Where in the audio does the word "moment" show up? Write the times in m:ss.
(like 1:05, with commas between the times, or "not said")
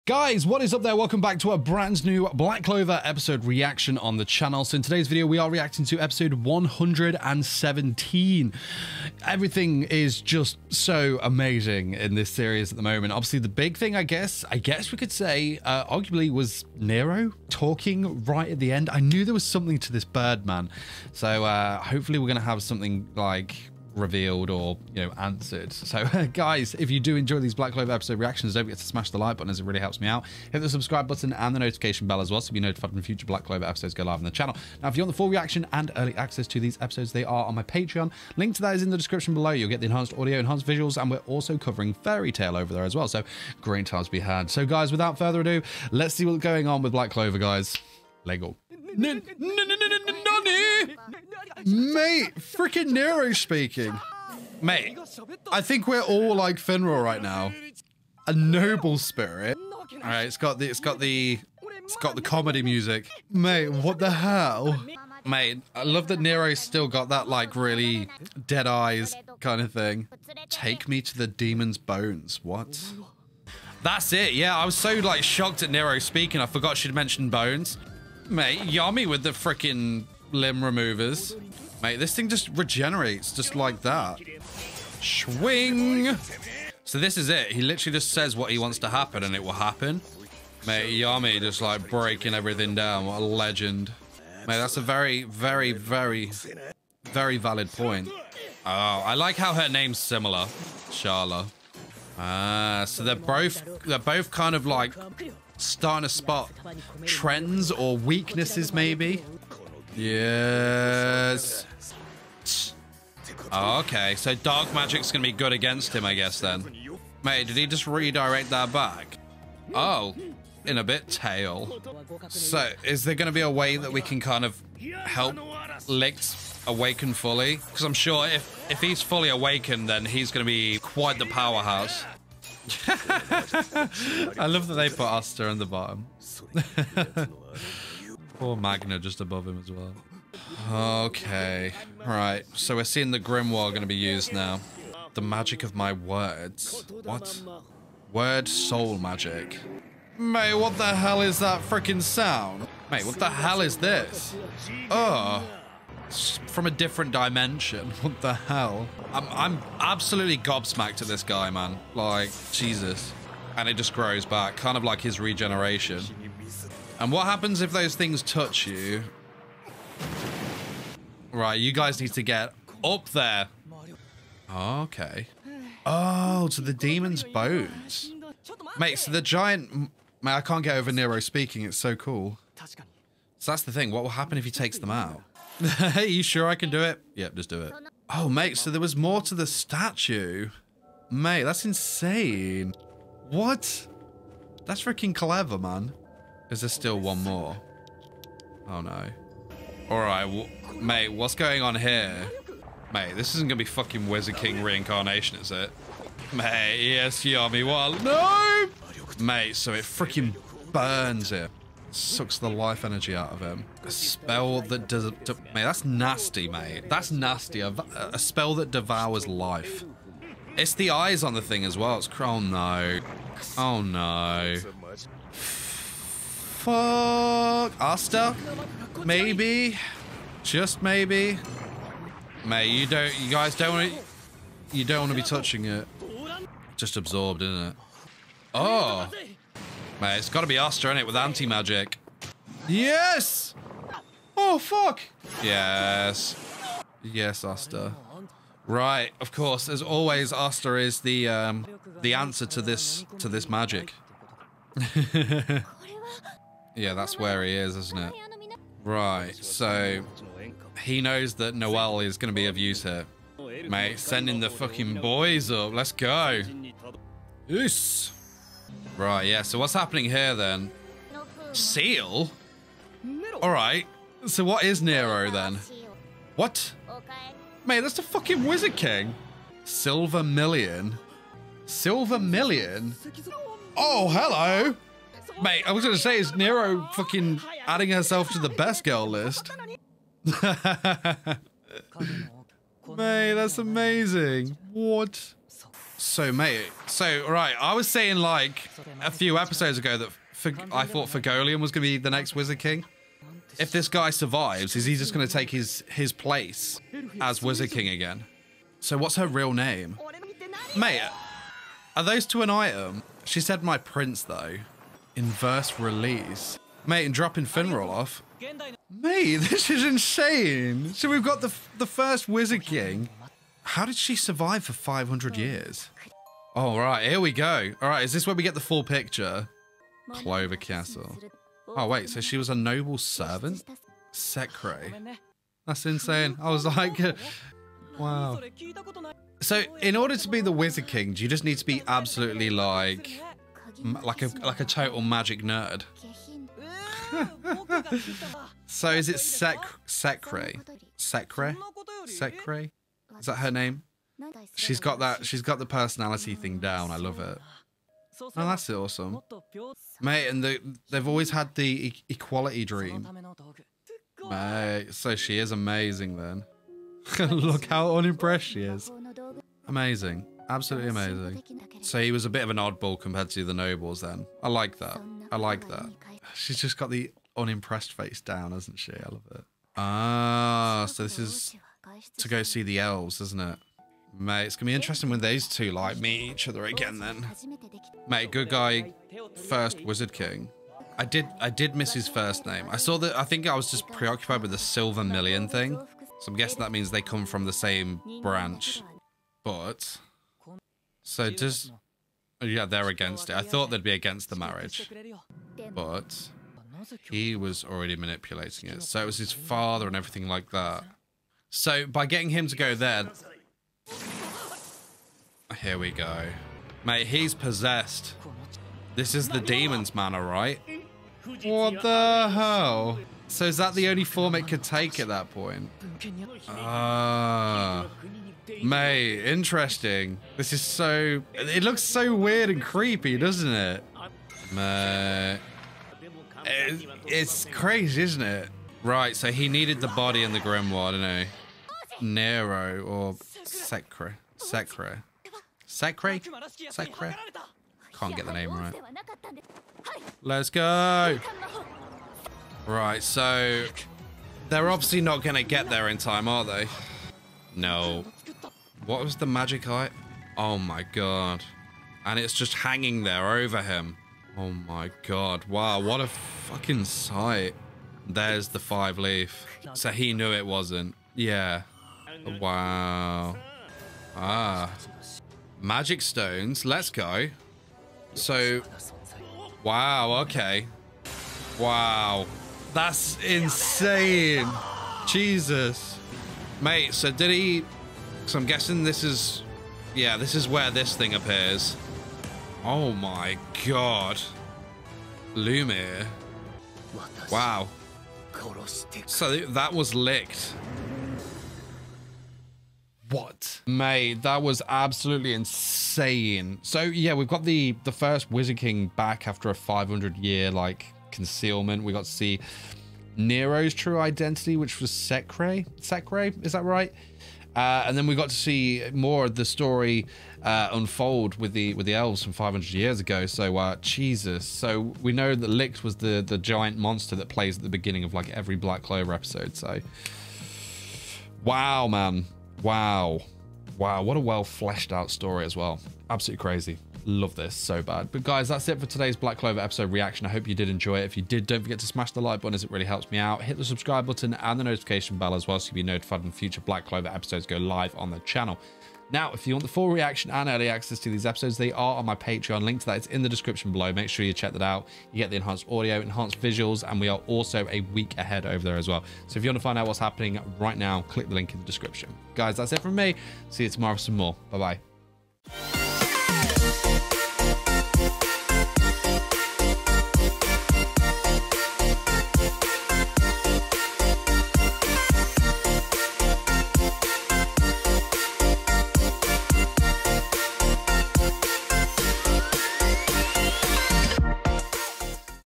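0:12.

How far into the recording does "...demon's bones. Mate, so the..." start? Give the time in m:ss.
2:56.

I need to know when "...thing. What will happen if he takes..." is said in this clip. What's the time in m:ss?
3:03.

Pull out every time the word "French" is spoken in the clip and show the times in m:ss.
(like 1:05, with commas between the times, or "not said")
not said.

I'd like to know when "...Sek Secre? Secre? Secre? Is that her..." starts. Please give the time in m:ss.
5:49.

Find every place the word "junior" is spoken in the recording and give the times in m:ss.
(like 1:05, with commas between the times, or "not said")
not said.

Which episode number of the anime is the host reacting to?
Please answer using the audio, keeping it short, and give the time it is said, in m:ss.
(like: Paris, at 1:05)
117, at 0:05.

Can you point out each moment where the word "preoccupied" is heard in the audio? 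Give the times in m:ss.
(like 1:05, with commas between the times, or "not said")
6:33.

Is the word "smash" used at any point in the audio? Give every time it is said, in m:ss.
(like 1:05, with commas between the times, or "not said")
0:28, 9:01.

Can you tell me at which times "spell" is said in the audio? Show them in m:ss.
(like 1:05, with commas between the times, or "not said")
3:33, 3:38.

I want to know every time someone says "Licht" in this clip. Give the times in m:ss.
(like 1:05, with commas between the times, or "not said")
2:05, 8:19, 8:45.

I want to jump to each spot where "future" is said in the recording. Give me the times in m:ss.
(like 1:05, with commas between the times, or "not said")
0:33, 9:06.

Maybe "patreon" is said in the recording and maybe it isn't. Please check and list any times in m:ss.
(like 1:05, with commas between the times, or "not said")
0:37, 9:12.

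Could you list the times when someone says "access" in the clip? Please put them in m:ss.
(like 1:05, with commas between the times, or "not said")
0:36, 9:10.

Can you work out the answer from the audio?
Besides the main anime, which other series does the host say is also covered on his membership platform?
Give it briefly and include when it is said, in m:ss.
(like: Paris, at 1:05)
Fairy Tail, at 0:41.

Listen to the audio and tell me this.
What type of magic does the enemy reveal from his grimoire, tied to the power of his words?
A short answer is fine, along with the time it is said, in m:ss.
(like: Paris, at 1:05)
Word soul magic, at 2:28.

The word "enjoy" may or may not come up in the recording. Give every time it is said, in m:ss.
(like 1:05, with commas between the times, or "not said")
0:27, 9:00.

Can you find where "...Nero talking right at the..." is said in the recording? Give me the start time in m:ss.
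0:16.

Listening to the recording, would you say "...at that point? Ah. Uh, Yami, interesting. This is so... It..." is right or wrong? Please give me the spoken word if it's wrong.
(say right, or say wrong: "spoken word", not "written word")
wrong: "May", not "Yami".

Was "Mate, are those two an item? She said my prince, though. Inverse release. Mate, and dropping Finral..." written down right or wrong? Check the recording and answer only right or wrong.
right.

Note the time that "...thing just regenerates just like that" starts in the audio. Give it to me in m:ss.
1:22.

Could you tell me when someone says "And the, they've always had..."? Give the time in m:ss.
6:00.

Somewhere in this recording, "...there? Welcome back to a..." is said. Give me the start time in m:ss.
0:00.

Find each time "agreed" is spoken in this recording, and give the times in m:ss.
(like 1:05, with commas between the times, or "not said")
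not said.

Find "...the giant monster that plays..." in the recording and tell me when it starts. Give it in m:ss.
8:46.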